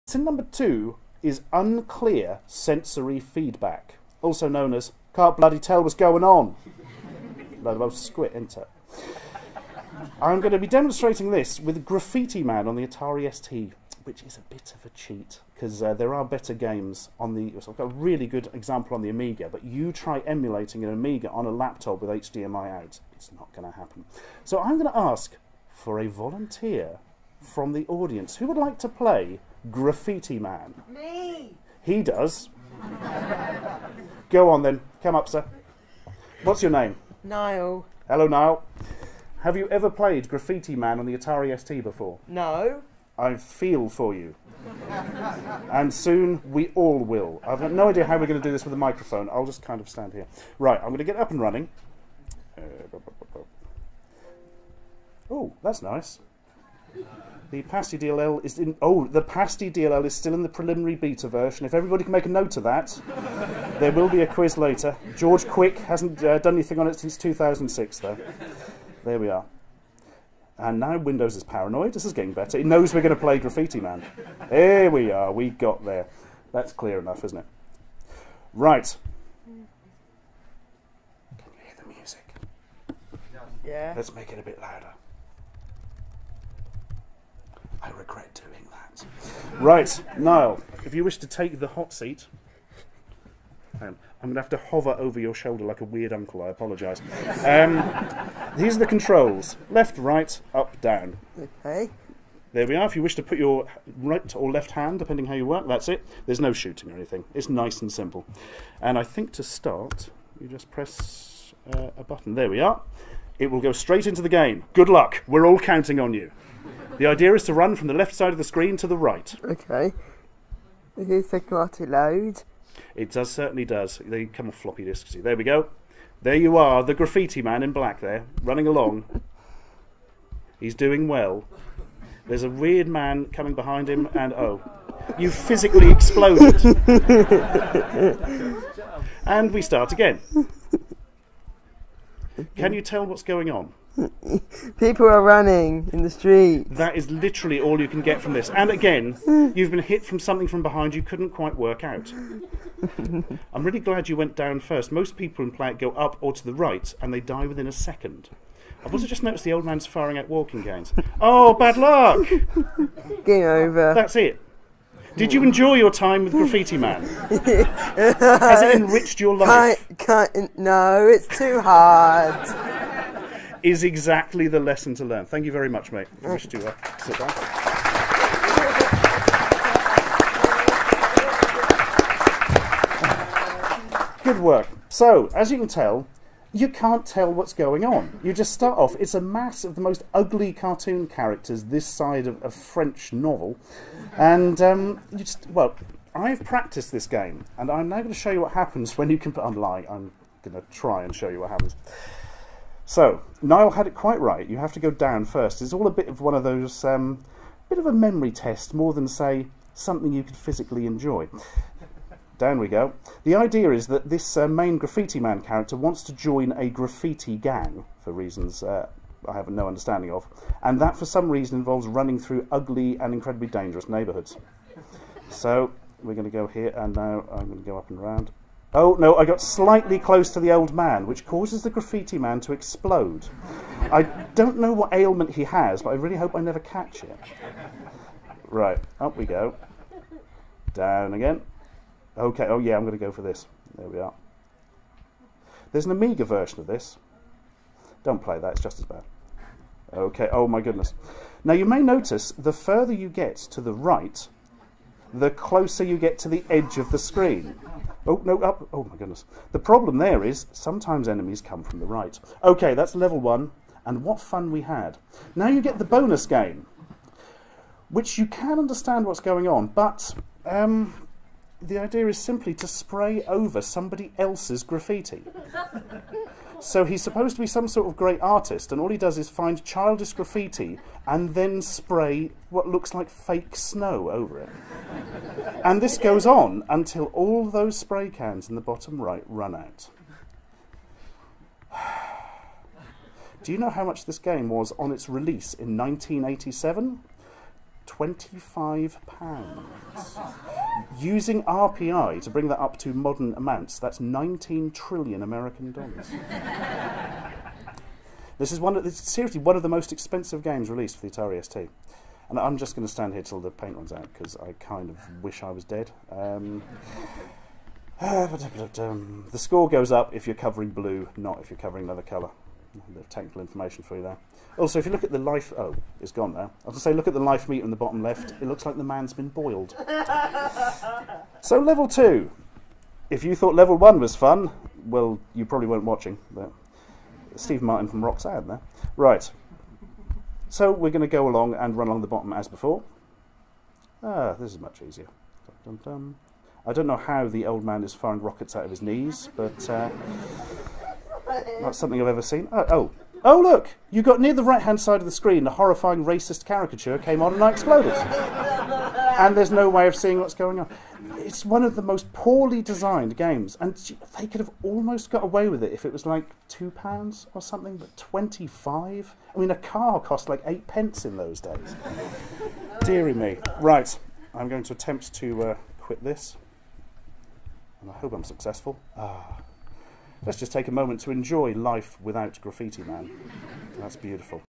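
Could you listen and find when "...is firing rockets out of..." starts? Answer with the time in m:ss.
5:47.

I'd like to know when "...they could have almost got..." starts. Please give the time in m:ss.
6:04.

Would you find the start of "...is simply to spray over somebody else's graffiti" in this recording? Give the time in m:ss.
4:32.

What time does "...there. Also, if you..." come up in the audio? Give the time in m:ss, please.
5:24.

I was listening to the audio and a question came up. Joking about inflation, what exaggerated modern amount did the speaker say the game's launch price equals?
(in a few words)
19 trillion American dollars.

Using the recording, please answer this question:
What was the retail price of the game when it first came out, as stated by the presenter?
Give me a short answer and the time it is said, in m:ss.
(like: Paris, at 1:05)
£25, at 4:57.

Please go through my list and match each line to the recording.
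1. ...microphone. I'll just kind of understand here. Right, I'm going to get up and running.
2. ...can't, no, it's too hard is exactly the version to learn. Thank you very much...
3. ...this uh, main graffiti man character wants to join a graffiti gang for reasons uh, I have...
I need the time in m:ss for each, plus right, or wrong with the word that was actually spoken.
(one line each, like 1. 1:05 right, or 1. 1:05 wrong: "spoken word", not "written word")
1. 0:48 wrong: "stand", not "understand"
2. 2:50 wrong: "lesson", not "version"
3. 3:34 right.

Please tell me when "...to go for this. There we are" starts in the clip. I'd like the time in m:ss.
4:02.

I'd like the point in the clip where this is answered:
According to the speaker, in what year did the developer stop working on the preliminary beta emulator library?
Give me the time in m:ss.
1:07.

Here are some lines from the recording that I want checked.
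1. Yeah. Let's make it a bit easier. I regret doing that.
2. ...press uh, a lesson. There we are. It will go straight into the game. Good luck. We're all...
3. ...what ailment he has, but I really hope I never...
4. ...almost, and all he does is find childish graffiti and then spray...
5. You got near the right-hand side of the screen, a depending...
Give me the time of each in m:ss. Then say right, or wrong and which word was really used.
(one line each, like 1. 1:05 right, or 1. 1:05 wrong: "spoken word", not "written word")
1. 1:23 wrong: "louder", not "easier"
2. 1:50 wrong: "button", not "lesson"
3. 3:54 right
4. 4:38 wrong: "artist", not "almost"
5. 5:53 wrong: "horrifying", not "depending".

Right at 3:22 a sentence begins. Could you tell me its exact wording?
So Niall had it quite right.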